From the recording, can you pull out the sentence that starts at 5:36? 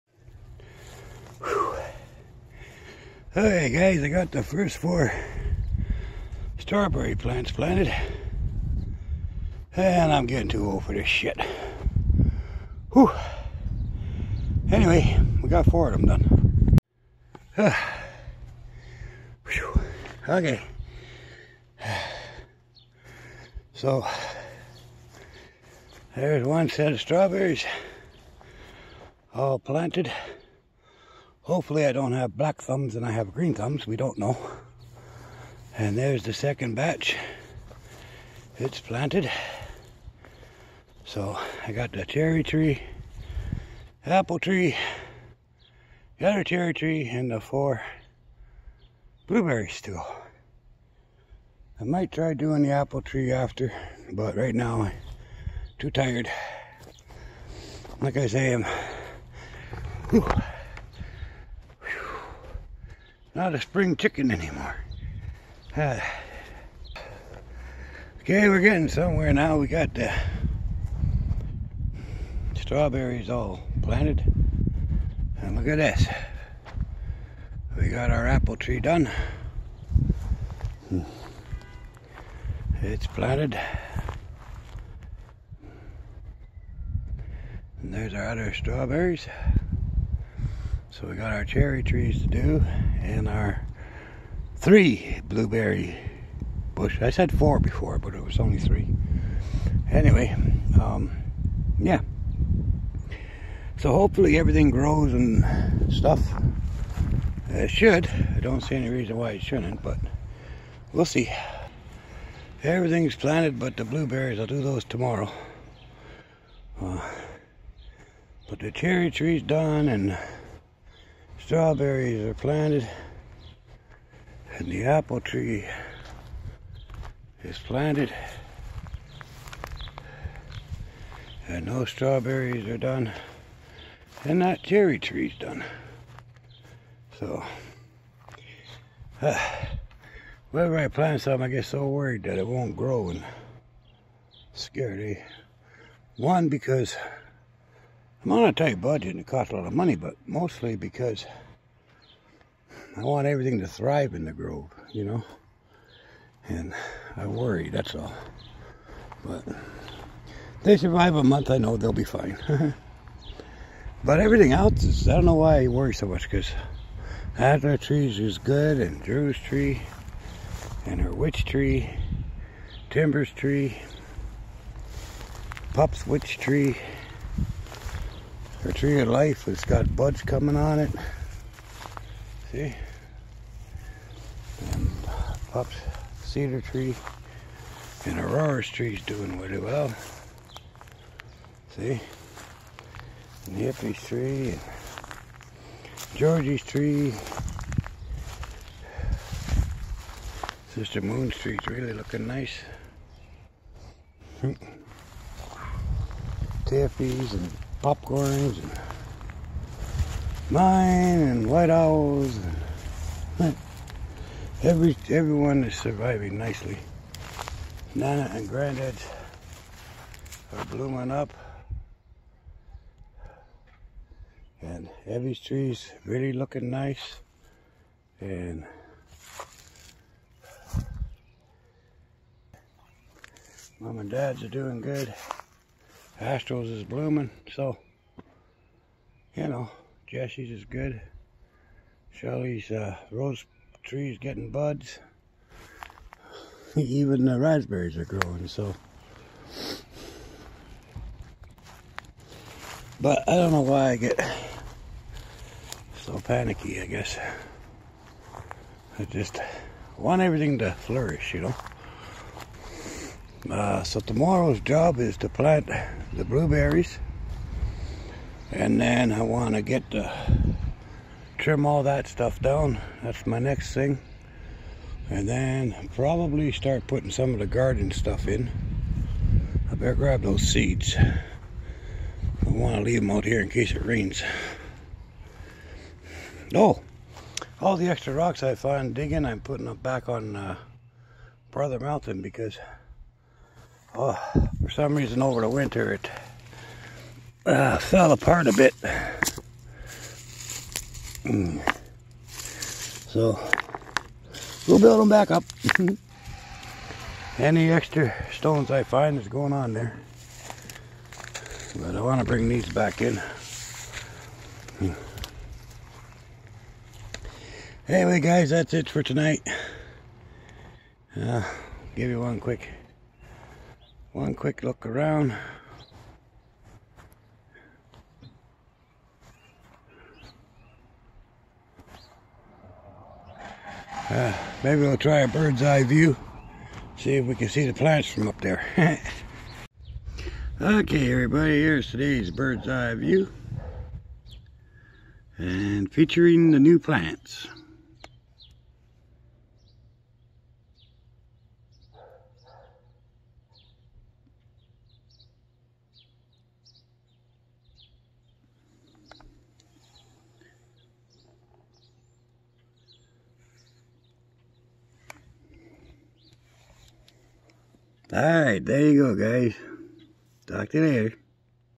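See if we can see the plants from up there.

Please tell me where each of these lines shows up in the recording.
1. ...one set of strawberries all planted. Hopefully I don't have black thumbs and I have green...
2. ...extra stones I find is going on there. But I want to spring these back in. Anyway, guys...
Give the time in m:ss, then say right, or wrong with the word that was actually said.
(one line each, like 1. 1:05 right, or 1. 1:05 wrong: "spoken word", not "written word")
1. 0:26 right
2. 5:07 wrong: "bring", not "spring".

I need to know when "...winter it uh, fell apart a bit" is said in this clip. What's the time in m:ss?
4:55.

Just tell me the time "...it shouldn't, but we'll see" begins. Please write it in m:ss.
1:49.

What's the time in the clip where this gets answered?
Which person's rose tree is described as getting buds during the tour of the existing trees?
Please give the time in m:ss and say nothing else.
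4:02.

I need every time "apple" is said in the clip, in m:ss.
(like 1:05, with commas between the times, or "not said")
0:44, 0:52, 1:18, 2:04.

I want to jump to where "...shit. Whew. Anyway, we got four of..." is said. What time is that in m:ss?
0:11.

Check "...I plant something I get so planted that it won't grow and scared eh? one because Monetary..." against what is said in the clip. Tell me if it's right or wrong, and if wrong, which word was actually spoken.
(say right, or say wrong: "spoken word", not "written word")
wrong: "worried", not "planted".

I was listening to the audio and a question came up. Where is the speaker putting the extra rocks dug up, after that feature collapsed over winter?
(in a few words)
Brother Mountain.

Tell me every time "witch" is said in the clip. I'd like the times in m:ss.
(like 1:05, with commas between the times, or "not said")
2:51, 2:56.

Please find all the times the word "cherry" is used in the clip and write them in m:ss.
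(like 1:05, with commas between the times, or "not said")
0:42, 0:46, 1:31, 1:58, 2:14.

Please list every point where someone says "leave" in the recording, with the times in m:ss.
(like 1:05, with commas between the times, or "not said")
4:42.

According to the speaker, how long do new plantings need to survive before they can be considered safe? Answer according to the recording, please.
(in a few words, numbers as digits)
A month.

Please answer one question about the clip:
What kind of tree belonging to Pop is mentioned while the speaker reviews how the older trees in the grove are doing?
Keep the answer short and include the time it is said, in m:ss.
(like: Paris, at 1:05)
Cedar, at 3:06.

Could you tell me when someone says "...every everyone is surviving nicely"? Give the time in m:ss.
3:34.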